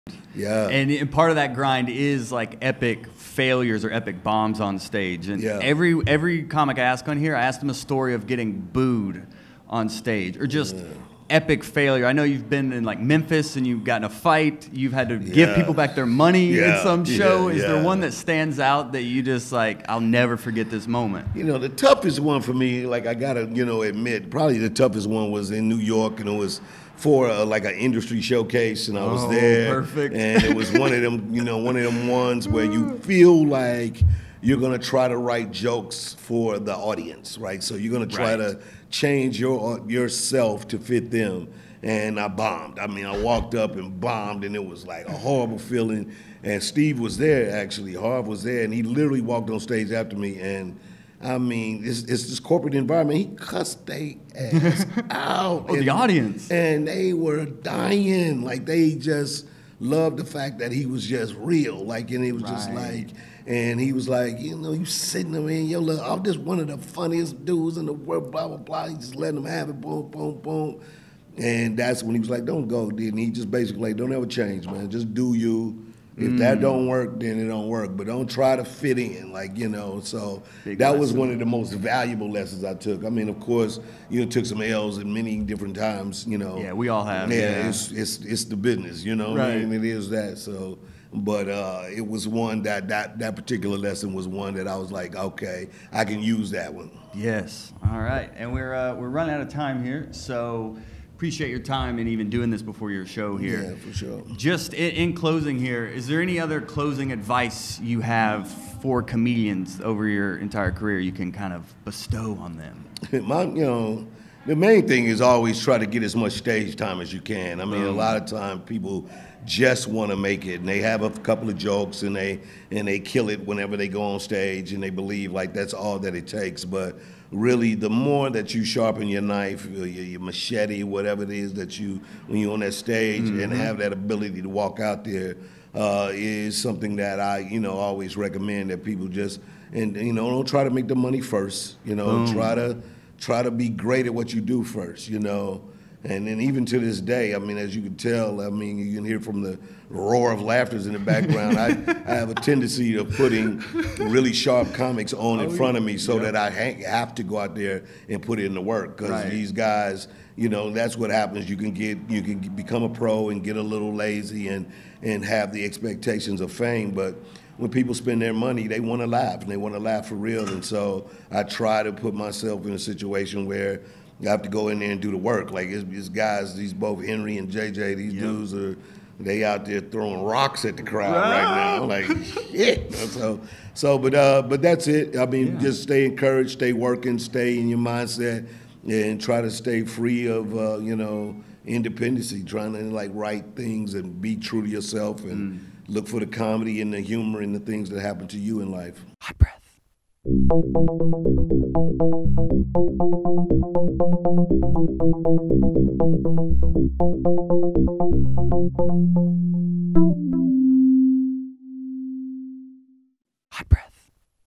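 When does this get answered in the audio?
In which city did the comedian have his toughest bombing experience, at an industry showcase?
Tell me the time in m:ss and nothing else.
0:25.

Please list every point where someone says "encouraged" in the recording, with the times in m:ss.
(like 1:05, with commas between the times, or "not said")
3:06.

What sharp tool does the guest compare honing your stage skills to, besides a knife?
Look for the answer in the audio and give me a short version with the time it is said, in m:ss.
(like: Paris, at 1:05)
machete, at 2:10.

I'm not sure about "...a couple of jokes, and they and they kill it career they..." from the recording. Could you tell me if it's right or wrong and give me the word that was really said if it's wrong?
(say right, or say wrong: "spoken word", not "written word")
wrong: "whenever", not "career".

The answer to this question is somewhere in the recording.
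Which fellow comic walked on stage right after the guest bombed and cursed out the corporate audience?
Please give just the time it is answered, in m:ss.
0:47.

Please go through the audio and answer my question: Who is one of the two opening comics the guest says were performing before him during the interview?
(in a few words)
Henry.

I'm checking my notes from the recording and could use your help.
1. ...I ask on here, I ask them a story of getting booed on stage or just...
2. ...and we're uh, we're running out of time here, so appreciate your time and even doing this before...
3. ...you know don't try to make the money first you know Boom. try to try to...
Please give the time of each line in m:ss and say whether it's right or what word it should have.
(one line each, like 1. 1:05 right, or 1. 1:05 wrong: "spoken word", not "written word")
1. 0:06 right
2. 1:38 right
3. 2:19 right.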